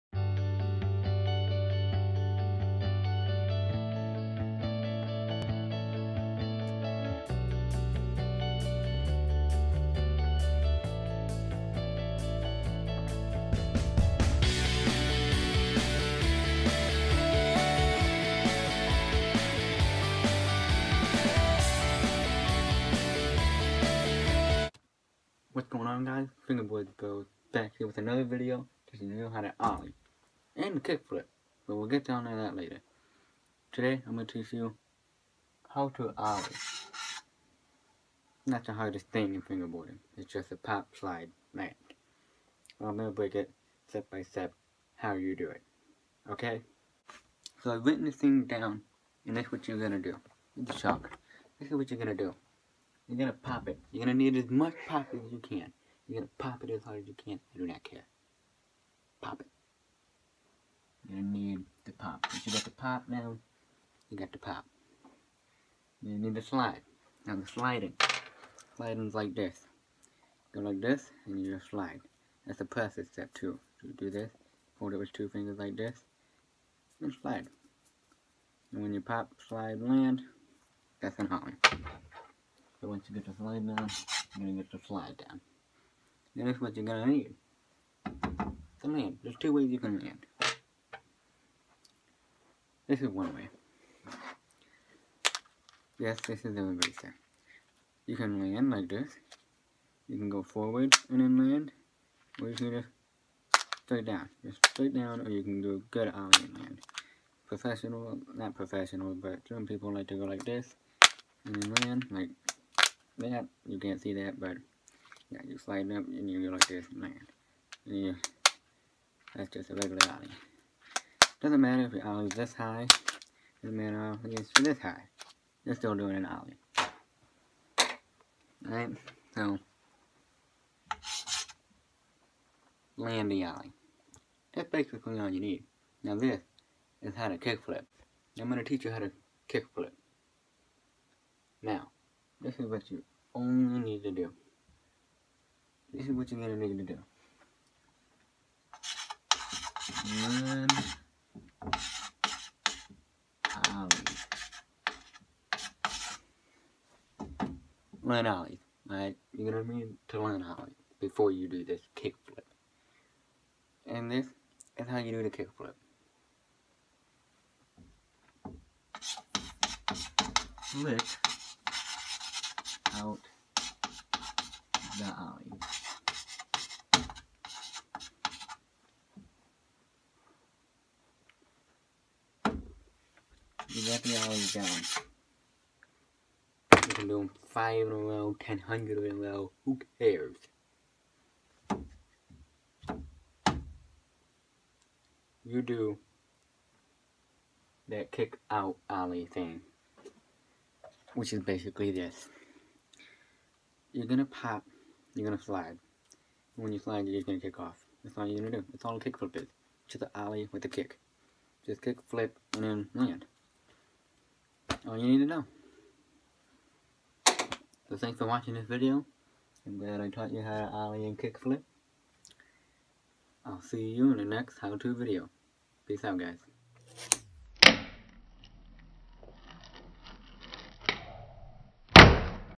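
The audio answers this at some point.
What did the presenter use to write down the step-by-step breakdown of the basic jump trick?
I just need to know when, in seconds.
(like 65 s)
50 s.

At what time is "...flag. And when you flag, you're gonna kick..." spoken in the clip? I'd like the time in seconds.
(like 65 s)
205 s.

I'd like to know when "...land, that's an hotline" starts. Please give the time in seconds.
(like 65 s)
79 s.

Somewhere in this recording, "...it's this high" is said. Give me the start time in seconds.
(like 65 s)
124 s.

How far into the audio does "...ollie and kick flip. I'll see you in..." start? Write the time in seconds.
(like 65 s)
220 s.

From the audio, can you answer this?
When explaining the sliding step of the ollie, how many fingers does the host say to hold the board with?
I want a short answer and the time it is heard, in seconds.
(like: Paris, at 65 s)
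2, at 75 s.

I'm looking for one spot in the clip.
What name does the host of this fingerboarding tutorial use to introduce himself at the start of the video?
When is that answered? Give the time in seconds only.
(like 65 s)
26 s.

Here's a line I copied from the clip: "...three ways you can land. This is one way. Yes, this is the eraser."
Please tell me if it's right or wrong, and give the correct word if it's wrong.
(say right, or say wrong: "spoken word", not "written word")
wrong: "two", not "three".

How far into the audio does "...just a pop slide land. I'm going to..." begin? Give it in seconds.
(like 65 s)
40 s.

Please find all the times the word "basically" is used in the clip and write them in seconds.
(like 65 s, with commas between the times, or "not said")
134 s, 201 s.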